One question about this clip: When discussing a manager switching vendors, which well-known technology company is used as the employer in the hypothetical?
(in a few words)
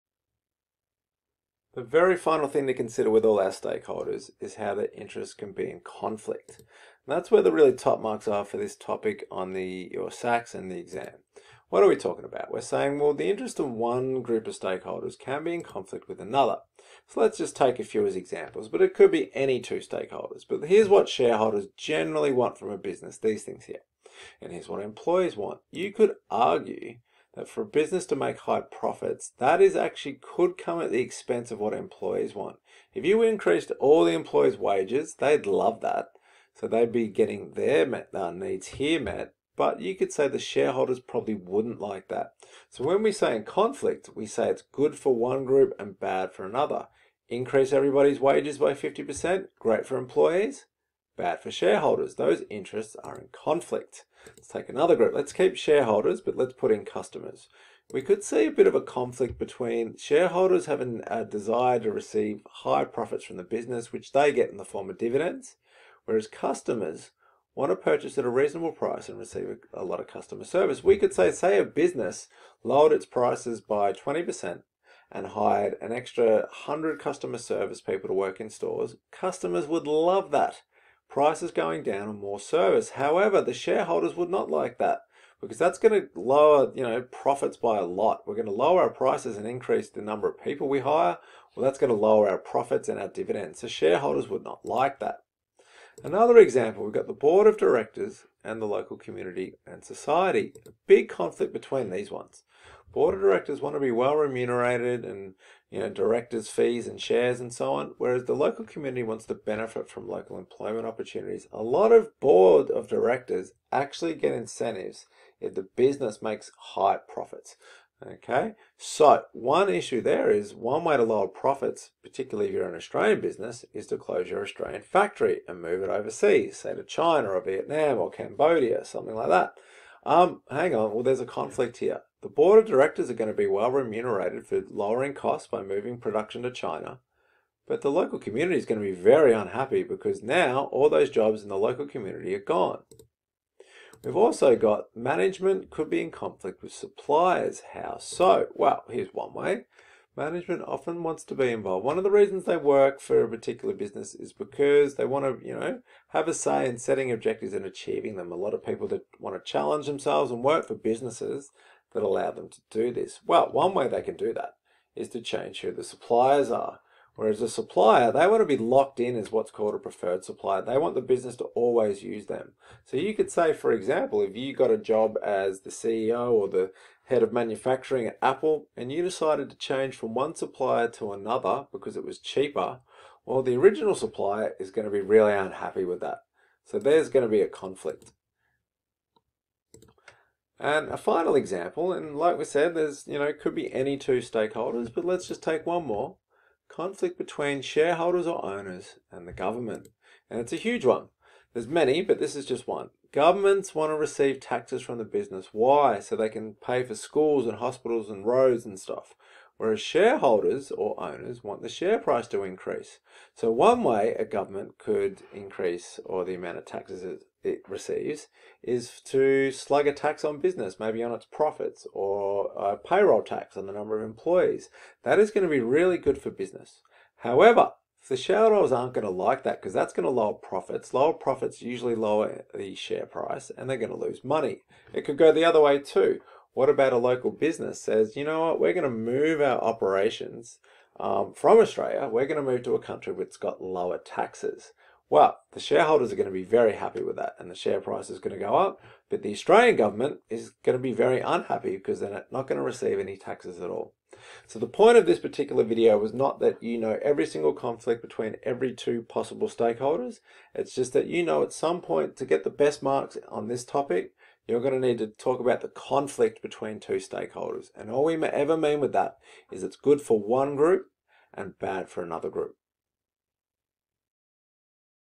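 Apple.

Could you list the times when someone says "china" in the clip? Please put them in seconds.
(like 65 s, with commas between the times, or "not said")
126 s, 136 s.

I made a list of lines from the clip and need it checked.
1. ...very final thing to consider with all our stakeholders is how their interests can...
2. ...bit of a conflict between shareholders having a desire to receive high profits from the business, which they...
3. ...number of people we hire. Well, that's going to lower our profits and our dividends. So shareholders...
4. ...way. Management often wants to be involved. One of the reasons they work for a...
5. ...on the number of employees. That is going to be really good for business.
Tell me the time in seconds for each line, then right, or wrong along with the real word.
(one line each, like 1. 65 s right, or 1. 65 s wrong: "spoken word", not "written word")
1. 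1 s right
2. 58 s right
3. 90 s right
4. 149 s right
5. 223 s right.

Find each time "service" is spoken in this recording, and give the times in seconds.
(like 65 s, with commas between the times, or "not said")
70 s, 77 s, 82 s.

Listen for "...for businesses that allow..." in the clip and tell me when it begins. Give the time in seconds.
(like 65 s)
160 s.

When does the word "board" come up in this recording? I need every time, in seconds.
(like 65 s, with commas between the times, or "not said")
97 s, 102 s, 112 s, 132 s.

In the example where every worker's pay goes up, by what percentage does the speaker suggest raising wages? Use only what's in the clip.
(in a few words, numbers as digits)
50%.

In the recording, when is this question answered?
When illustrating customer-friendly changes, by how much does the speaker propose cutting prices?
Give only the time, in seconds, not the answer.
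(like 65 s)
73 s.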